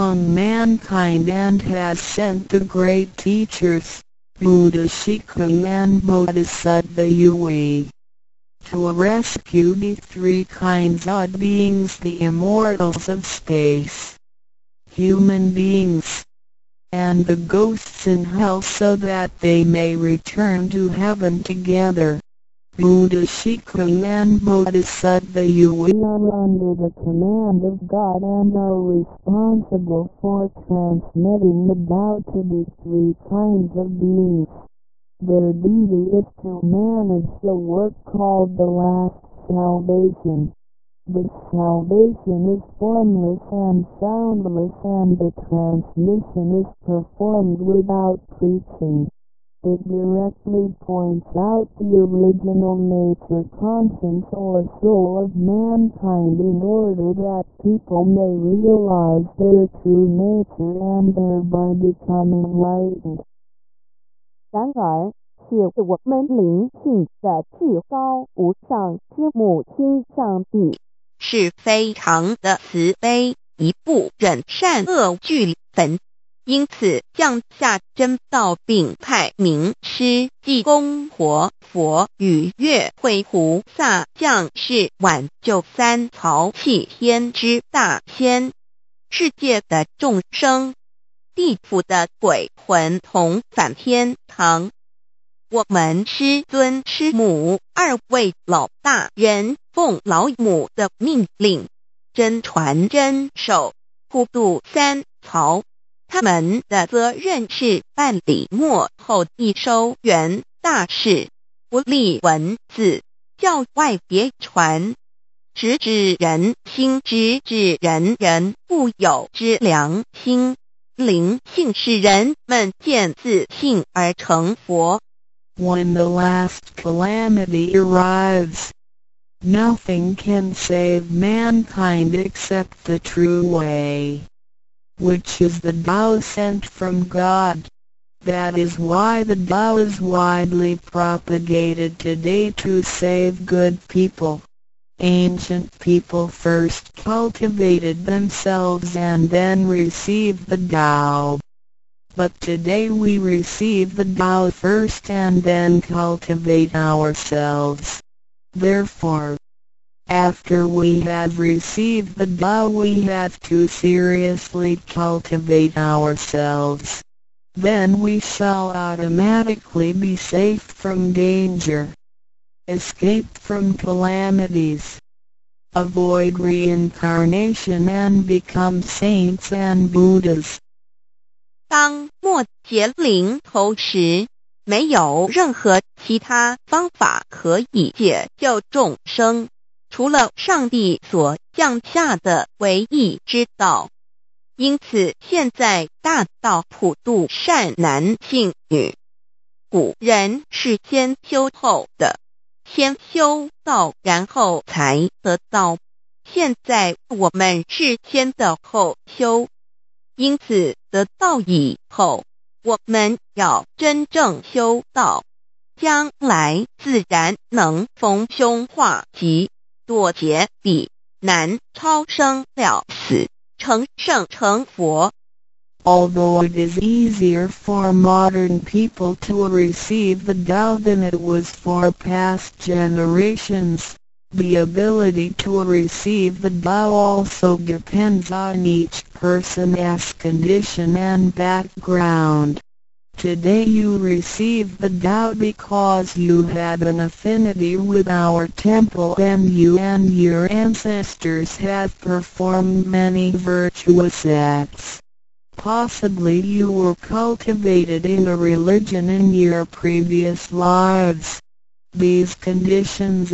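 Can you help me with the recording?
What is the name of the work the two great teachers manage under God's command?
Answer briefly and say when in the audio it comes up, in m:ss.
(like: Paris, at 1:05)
the last salvation, at 0:38.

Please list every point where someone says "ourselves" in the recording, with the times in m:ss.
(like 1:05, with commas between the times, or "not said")
2:36, 2:45.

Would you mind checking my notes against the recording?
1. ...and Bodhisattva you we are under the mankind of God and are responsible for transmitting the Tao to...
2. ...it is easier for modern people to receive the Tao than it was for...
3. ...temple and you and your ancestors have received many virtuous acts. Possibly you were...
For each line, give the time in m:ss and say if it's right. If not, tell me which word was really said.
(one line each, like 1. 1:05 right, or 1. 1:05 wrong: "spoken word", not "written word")
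1. 0:24 wrong: "command", not "mankind"
2. 3:46 right
3. 4:08 wrong: "performed", not "received".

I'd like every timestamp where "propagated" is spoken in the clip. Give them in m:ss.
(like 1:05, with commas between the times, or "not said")
2:20.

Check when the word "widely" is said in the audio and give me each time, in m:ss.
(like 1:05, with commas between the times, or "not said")
2:19.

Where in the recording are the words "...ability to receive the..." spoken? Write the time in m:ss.
3:54.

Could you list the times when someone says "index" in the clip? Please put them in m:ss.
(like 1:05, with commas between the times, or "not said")
not said.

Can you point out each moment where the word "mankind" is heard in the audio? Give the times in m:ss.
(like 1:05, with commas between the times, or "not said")
0:00, 0:55, 2:11.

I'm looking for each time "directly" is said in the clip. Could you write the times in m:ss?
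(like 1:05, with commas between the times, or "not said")
0:49.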